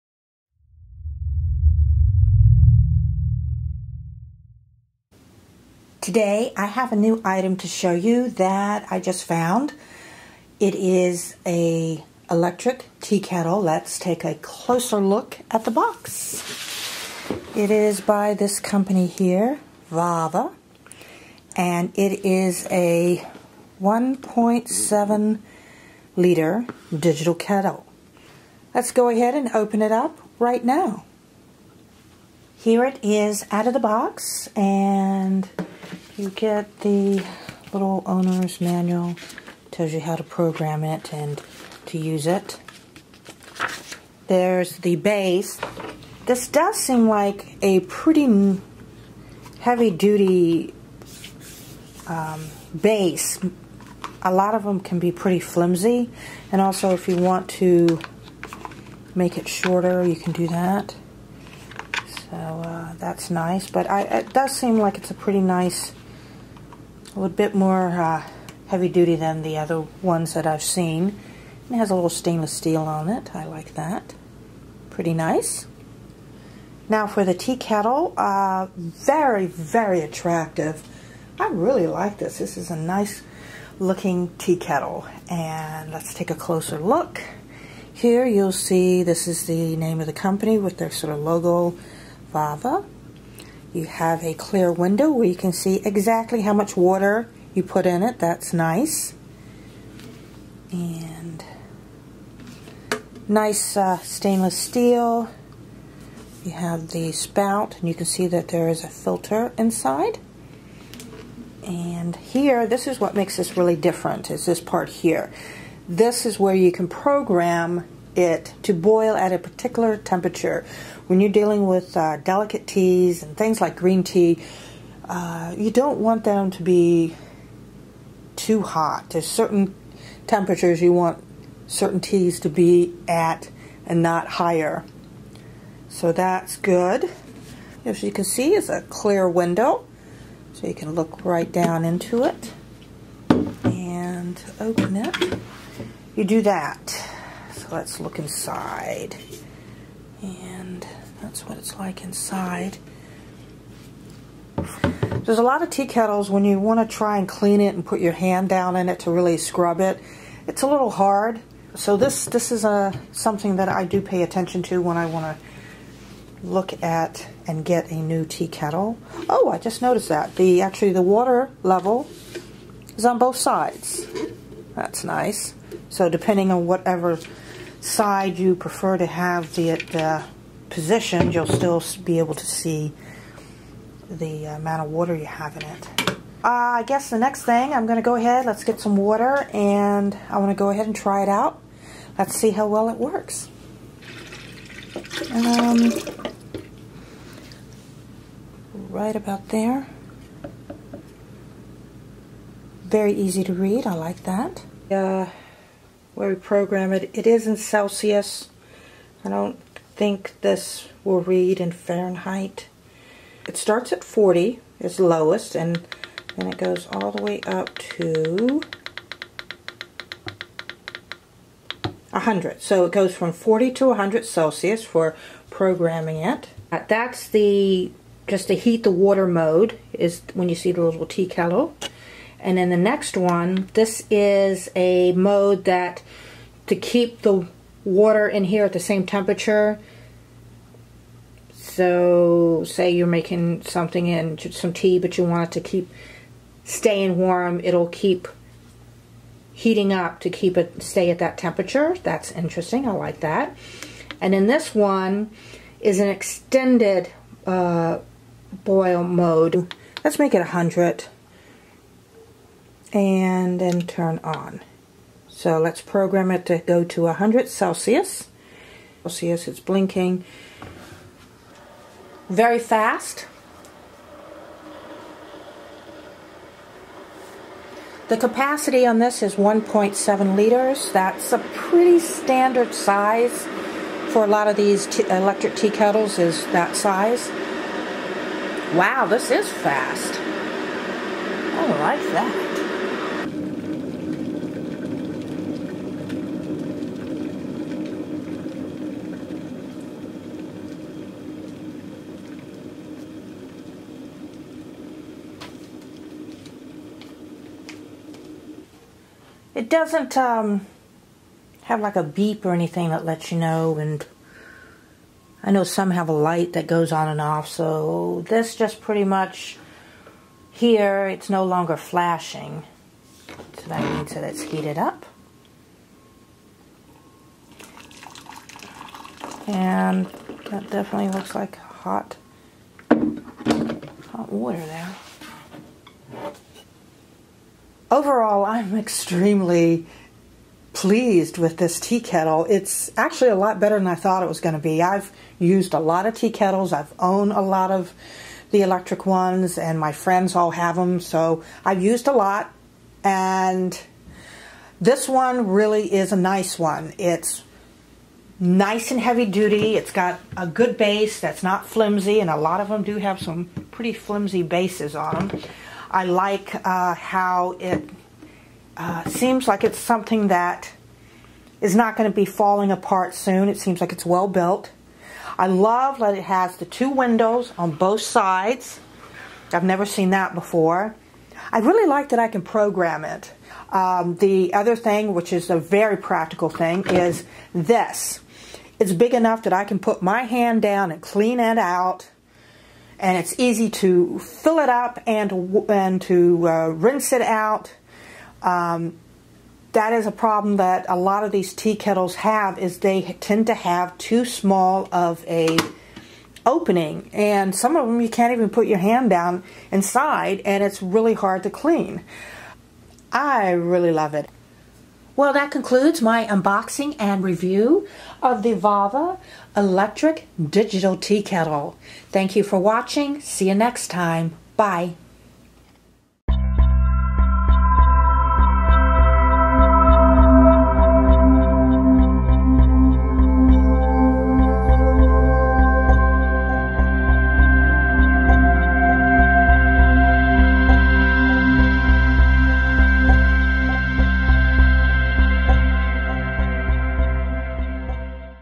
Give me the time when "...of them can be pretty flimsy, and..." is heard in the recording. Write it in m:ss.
0:54.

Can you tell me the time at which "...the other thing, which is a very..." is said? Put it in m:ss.
6:24.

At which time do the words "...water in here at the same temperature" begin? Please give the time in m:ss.
3:57.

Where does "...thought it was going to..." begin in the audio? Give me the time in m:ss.
5:43.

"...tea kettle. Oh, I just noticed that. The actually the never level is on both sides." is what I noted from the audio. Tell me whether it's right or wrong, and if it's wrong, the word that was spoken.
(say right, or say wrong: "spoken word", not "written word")
wrong: "water", not "never".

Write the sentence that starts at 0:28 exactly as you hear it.
Let's go ahead and open it up right now.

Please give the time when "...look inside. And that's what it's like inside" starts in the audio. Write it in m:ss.
2:27.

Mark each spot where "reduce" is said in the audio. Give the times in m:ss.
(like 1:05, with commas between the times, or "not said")
not said.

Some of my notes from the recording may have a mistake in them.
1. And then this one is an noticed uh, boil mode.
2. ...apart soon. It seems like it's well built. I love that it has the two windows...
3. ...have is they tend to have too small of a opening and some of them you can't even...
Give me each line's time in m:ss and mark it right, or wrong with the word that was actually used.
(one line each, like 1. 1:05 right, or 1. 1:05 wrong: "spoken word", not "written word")
1. 4:14 wrong: "extended", not "noticed"
2. 6:12 right
3. 6:42 right.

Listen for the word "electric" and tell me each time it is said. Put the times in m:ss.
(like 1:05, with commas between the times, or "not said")
0:12, 4:44, 5:48, 6:59.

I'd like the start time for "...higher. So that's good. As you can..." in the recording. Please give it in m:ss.
2:14.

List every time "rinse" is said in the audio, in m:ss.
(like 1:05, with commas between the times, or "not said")
6:36.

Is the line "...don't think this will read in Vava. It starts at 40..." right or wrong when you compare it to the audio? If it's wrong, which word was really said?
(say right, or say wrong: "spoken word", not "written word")
wrong: "Fahrenheit", not "Vava".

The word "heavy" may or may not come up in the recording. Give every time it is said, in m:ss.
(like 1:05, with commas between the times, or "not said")
0:49, 1:08, 5:58.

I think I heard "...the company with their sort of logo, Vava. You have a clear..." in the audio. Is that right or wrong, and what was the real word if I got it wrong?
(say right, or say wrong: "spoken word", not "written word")
right.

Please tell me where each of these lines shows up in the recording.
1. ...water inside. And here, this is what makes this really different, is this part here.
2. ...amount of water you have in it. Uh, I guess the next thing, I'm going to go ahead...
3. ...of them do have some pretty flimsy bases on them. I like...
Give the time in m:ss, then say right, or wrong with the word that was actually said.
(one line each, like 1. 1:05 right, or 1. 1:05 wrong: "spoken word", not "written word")
1. 1:48 wrong: "filter", not "water"
2. 3:04 right
3. 6:02 right.